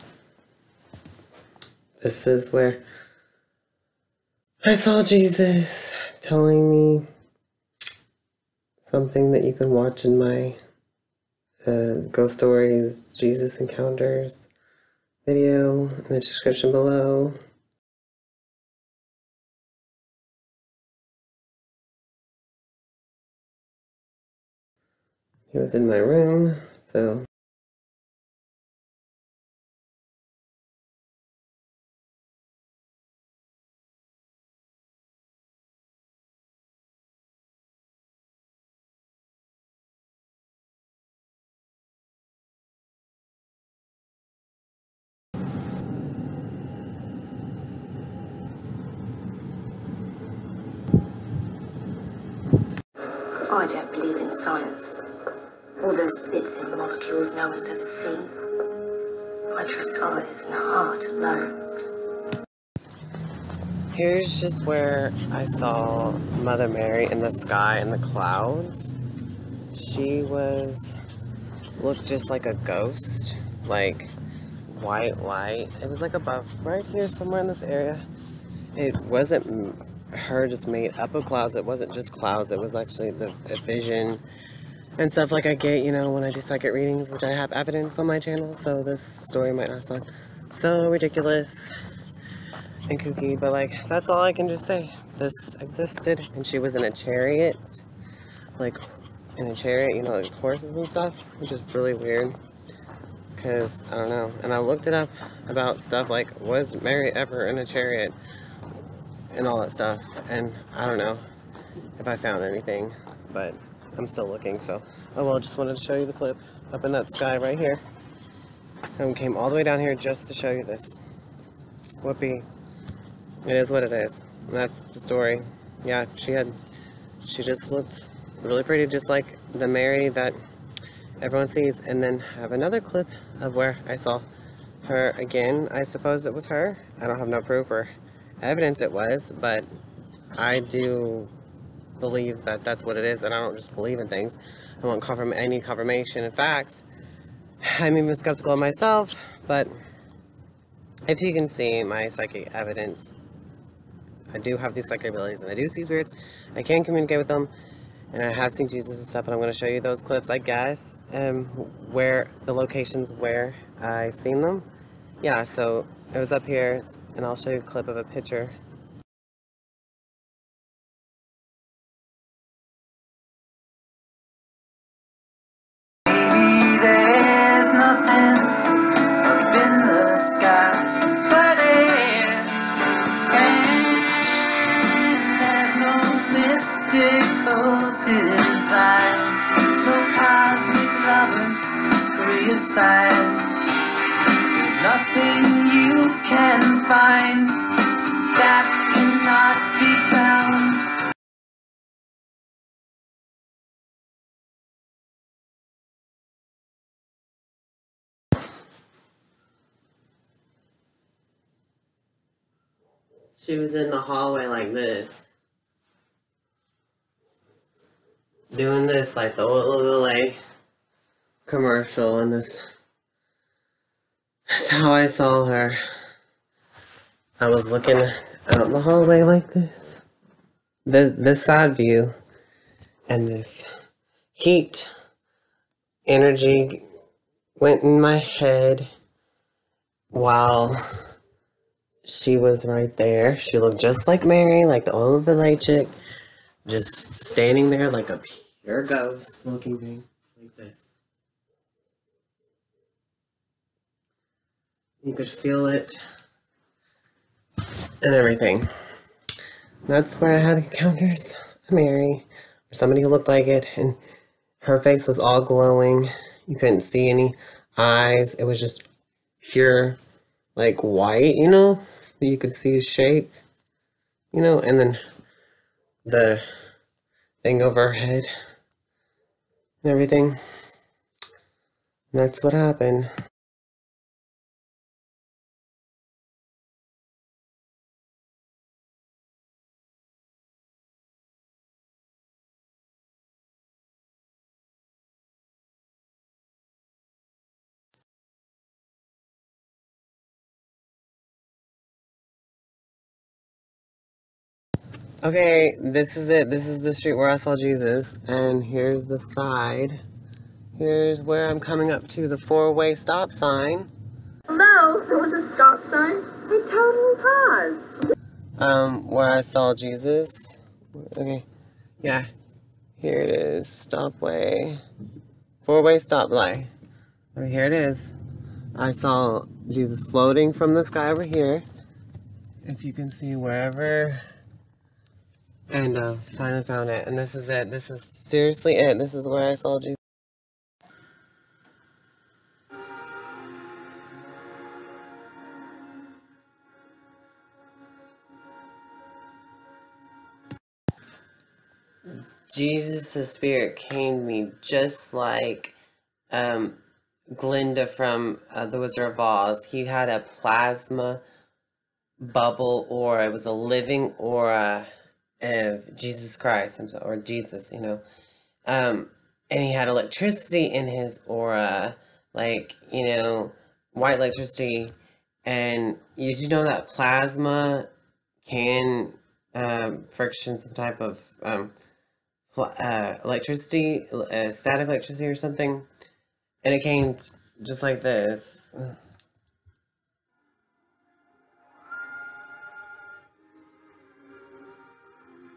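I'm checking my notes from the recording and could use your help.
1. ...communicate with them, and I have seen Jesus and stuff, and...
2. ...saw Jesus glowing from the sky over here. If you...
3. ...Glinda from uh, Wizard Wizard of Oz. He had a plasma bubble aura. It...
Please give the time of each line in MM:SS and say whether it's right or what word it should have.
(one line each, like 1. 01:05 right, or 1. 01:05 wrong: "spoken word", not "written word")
1. 02:36 right
2. 05:28 wrong: "floating", not "glowing"
3. 05:57 wrong: "The", not "Wizard".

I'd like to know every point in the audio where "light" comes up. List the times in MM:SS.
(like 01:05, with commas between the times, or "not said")
01:15, 05:26.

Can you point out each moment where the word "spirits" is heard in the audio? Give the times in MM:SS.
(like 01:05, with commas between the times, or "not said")
02:35, 05:53.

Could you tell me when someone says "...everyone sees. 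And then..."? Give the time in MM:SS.
02:11.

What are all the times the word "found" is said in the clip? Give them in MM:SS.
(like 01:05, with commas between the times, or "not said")
01:52, 05:36.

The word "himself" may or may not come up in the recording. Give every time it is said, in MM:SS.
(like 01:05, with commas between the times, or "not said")
06:06.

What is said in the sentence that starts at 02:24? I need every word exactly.
I want confirm any confirmation and facts.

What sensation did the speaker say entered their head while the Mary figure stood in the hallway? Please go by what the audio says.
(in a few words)
heat energy.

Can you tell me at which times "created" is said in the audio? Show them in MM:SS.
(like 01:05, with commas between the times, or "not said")
not said.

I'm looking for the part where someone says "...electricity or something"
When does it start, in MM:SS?
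06:24.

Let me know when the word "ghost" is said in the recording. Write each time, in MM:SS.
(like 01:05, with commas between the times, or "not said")
00:12, 01:12, 04:08.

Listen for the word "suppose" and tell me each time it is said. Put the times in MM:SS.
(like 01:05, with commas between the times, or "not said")
02:15.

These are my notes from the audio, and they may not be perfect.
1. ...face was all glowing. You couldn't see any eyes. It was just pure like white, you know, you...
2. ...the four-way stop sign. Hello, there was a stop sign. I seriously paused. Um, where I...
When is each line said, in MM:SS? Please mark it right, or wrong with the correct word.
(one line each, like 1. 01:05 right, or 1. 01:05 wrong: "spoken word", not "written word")
1. 04:24 right
2. 05:12 wrong: "totally", not "seriously".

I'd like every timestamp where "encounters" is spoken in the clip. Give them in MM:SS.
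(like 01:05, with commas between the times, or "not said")
00:13, 04:20.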